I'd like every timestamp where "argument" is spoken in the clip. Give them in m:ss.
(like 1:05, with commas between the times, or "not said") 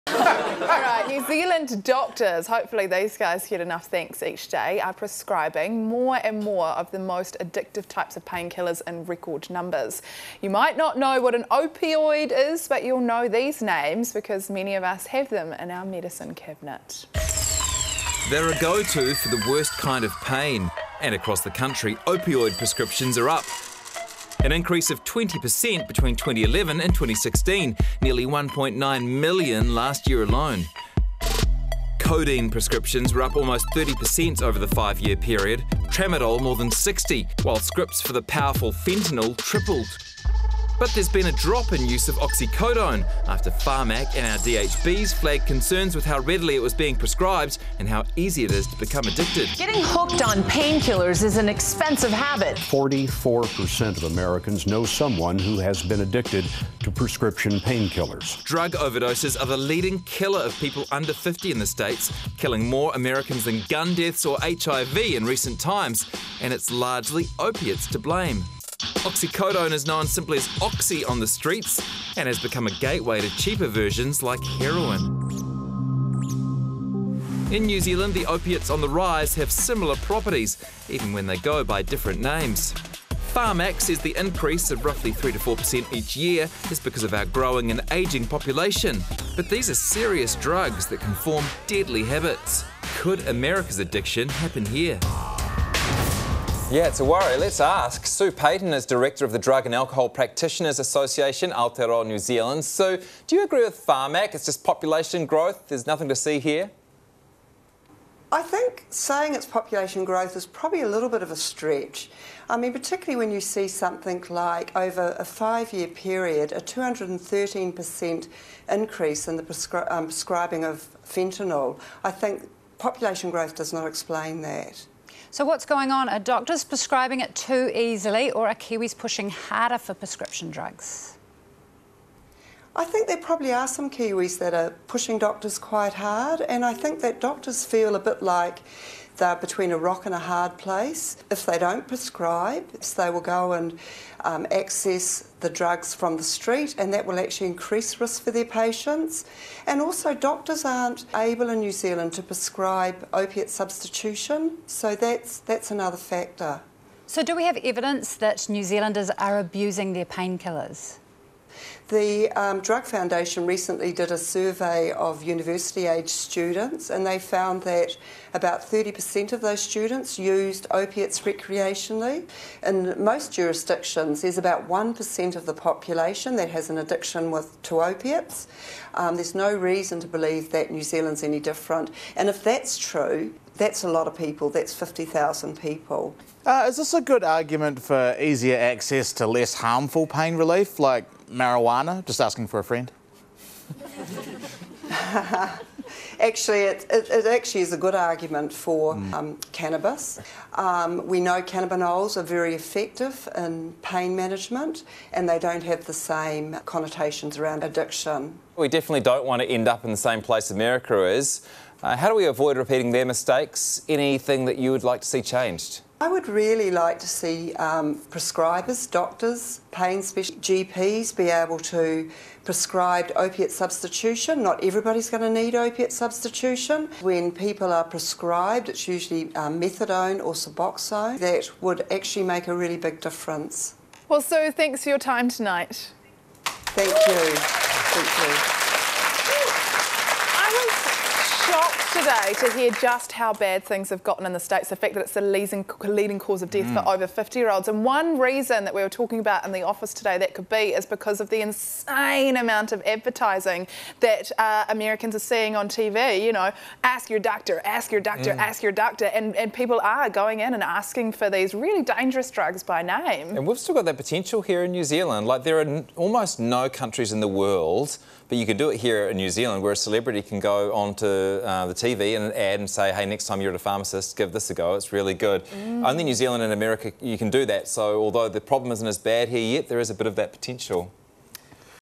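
3:07, 3:17.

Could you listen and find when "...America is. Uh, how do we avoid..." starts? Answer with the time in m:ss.
3:30.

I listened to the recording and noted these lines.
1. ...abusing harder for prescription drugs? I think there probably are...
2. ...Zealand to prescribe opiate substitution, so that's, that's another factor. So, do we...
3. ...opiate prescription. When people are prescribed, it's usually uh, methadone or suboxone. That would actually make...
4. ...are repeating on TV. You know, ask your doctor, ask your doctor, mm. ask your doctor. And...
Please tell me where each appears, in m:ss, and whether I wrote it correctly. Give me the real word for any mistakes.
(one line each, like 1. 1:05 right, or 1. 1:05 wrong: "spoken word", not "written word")
1. 2:08 wrong: "pushing", not "abusing"
2. 2:31 right
3. 3:45 wrong: "substitution", not "prescription"
4. 4:15 wrong: "seeing", not "repeating".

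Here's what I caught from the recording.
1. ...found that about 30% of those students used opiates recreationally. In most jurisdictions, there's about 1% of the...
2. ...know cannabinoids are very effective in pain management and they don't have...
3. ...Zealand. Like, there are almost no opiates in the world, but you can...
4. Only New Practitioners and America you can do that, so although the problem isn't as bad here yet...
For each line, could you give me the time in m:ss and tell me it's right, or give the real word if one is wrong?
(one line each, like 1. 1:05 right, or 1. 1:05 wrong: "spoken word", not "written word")
1. 2:47 right
2. 3:21 right
3. 4:24 wrong: "countries", not "opiates"
4. 4:35 wrong: "Zealand", not "Practitioners".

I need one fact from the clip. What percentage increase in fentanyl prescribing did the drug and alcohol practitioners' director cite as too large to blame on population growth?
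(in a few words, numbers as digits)
213%.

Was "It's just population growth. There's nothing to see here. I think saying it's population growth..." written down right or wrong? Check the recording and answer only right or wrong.
right.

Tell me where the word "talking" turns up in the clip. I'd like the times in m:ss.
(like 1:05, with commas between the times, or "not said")
4:08.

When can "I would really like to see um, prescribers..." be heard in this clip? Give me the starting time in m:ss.
3:35.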